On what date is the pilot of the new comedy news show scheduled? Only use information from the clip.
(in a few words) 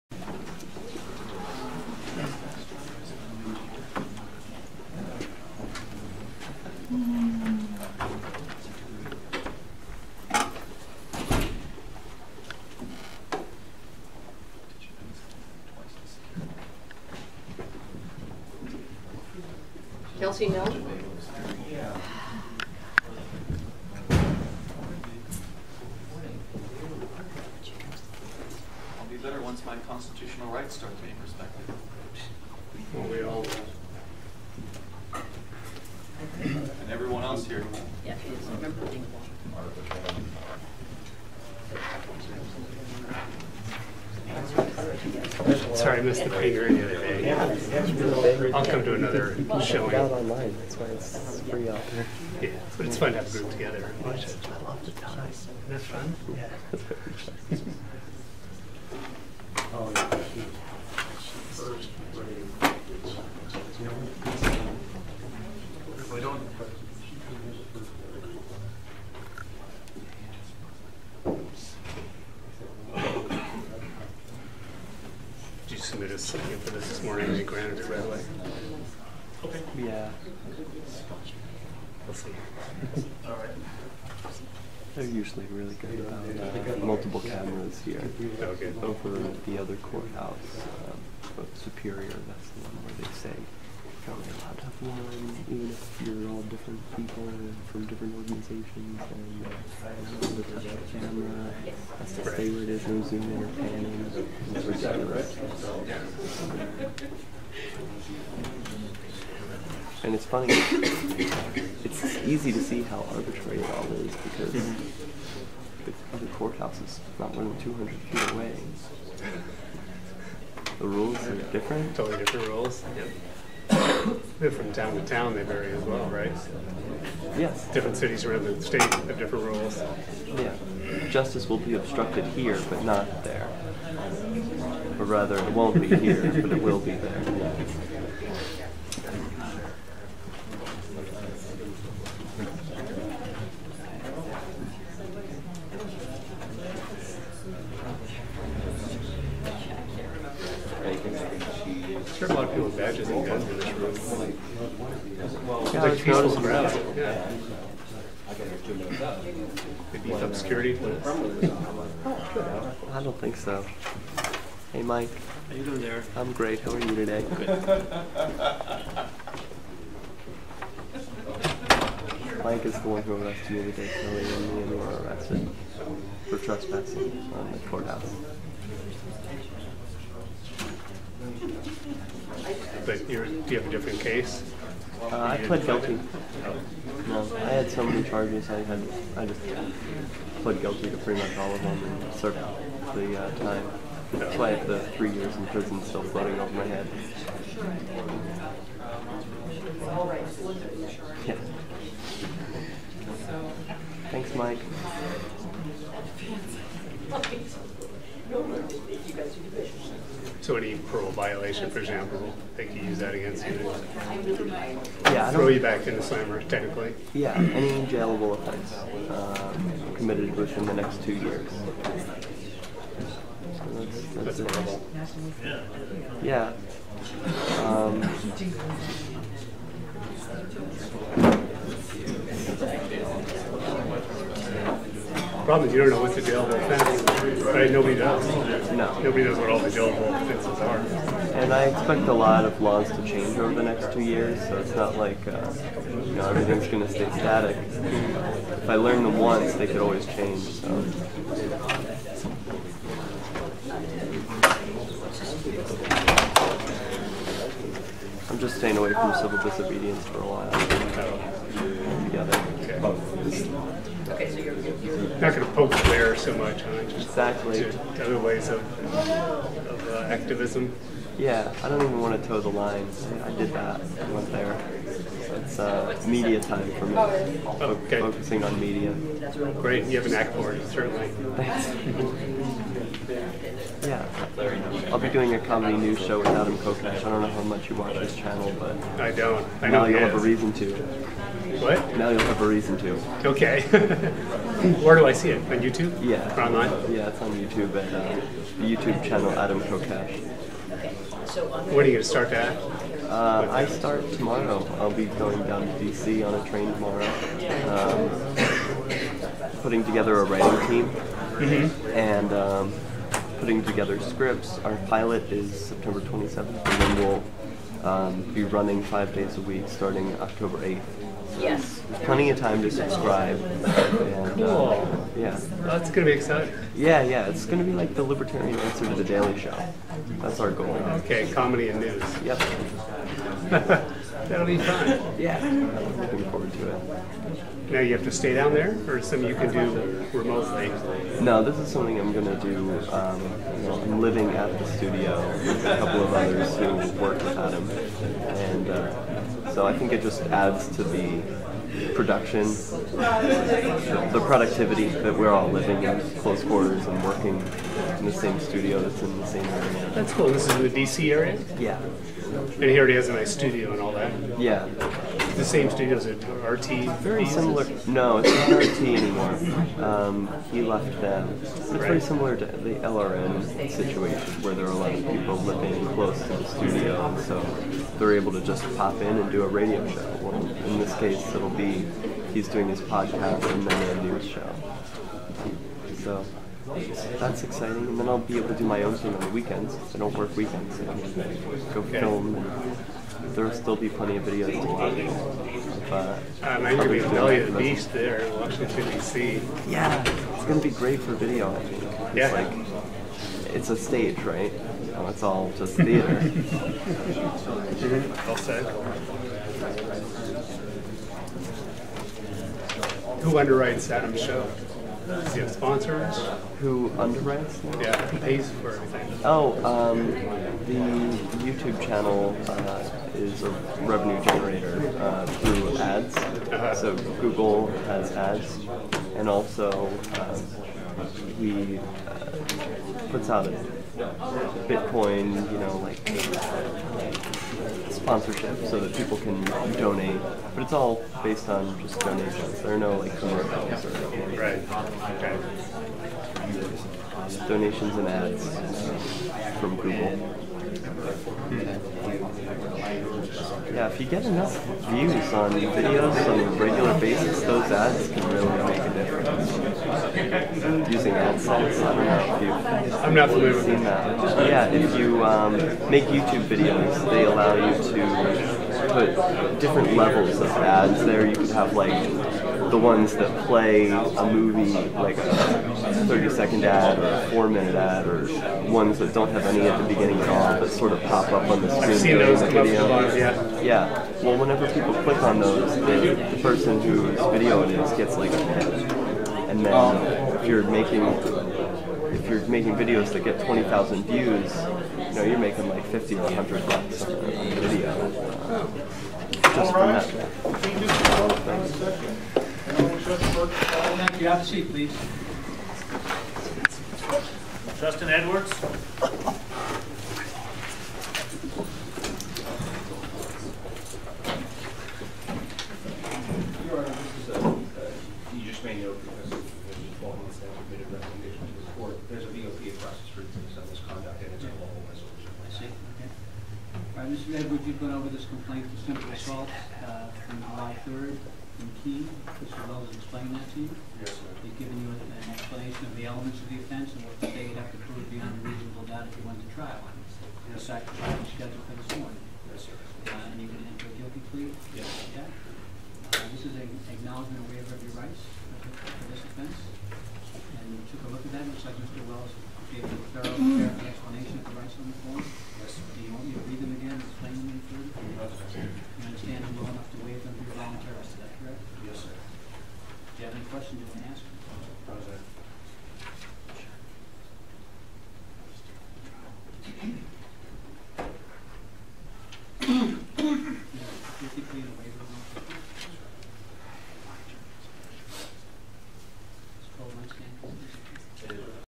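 September 27th.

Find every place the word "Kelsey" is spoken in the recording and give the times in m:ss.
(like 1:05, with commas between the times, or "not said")
0:20.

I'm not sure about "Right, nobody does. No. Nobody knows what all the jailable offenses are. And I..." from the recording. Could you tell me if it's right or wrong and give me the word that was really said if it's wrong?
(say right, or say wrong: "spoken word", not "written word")
right.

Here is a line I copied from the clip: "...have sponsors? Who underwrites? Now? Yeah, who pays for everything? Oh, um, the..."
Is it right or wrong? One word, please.
right.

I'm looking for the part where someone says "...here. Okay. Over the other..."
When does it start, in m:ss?
1:27.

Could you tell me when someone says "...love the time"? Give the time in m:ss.
0:54.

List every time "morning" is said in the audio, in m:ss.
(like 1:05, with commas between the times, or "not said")
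1:17, 9:02.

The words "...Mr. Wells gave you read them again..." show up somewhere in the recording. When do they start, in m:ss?
9:11.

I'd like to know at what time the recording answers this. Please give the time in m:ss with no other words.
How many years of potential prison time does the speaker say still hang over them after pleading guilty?
3:14.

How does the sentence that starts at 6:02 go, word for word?
And he already has a nice studio and all that.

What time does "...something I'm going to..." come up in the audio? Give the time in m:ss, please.
5:41.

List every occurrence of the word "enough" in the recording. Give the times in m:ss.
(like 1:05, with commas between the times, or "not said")
7:34, 9:19.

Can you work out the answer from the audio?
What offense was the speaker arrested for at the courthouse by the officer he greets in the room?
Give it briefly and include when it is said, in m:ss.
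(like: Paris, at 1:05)
Trespassing, at 2:56.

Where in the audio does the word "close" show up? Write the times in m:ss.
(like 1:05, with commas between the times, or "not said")
5:56, 6:15.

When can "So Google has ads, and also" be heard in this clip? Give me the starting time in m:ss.
7:06.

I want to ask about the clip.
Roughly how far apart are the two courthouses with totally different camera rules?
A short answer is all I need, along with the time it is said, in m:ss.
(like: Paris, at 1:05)
200 feet, at 1:57.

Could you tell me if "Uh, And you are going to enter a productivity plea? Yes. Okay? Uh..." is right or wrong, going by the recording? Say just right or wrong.
wrong.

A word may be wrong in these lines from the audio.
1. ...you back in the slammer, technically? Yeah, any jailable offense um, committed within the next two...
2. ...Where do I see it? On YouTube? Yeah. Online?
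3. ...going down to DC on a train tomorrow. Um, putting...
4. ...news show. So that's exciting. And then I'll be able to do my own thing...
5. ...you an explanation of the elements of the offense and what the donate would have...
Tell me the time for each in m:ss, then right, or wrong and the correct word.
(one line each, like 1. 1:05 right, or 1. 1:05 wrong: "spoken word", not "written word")
1. 3:35 right
2. 4:54 right
3. 5:05 right
4. 6:24 right
5. 8:54 wrong: "state", not "donate".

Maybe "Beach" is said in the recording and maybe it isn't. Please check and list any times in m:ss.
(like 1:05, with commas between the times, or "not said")
6:37.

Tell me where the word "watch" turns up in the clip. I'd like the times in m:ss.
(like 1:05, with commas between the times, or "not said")
4:47, 6:34.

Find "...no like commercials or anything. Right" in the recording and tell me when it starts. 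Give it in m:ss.
7:22.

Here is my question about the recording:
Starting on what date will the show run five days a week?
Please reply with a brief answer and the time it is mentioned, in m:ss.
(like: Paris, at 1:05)
October 8th, at 5:20.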